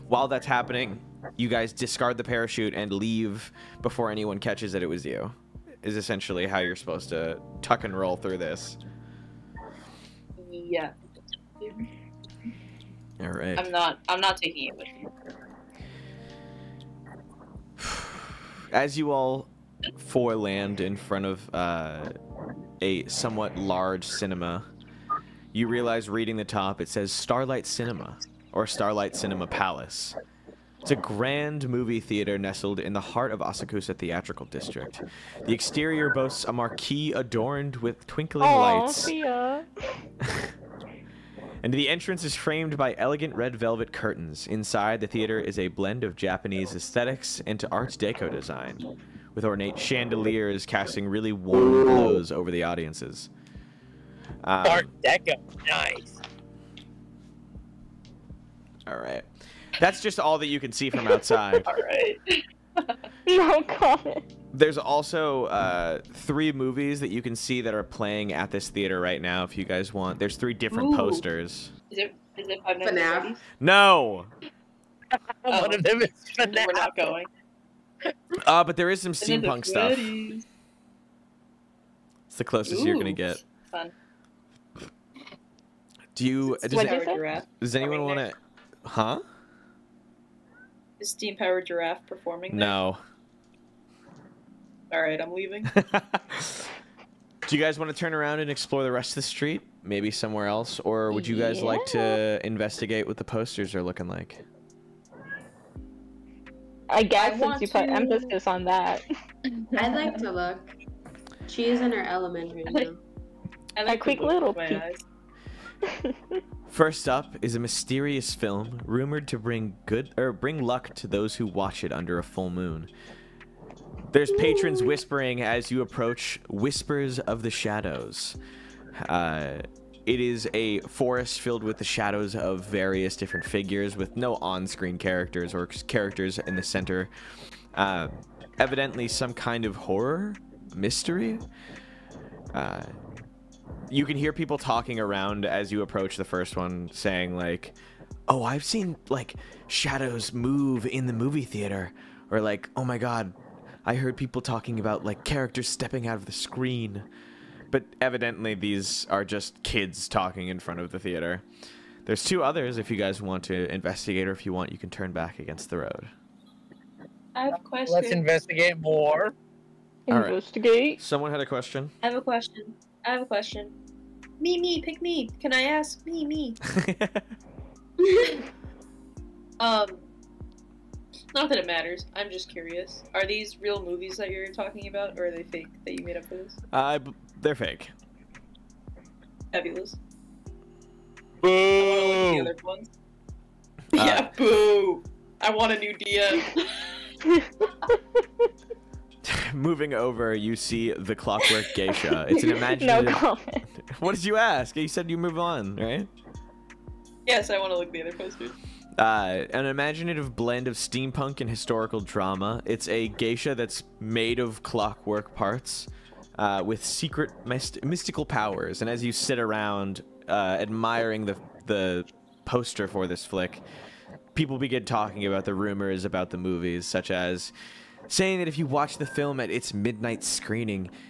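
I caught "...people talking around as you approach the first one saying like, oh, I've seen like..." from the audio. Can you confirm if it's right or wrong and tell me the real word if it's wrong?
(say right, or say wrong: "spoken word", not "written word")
right.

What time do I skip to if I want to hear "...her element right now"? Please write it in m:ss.
1:51.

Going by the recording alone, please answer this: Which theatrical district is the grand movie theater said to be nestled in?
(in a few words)
Asakusa.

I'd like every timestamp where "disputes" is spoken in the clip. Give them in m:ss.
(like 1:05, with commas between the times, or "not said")
not said.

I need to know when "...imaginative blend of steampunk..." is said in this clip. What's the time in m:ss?
3:29.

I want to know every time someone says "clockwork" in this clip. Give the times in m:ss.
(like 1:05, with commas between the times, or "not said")
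3:21, 3:34.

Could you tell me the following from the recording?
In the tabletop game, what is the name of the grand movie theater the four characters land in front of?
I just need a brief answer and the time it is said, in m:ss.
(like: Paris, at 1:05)
Starlight Cinema Palace, at 0:28.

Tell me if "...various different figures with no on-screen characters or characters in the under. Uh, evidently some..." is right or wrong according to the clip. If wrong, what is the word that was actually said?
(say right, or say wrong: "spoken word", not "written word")
wrong: "center", not "under".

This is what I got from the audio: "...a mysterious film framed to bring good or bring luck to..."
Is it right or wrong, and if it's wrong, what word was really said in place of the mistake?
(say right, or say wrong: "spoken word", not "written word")
wrong: "rumored", not "framed".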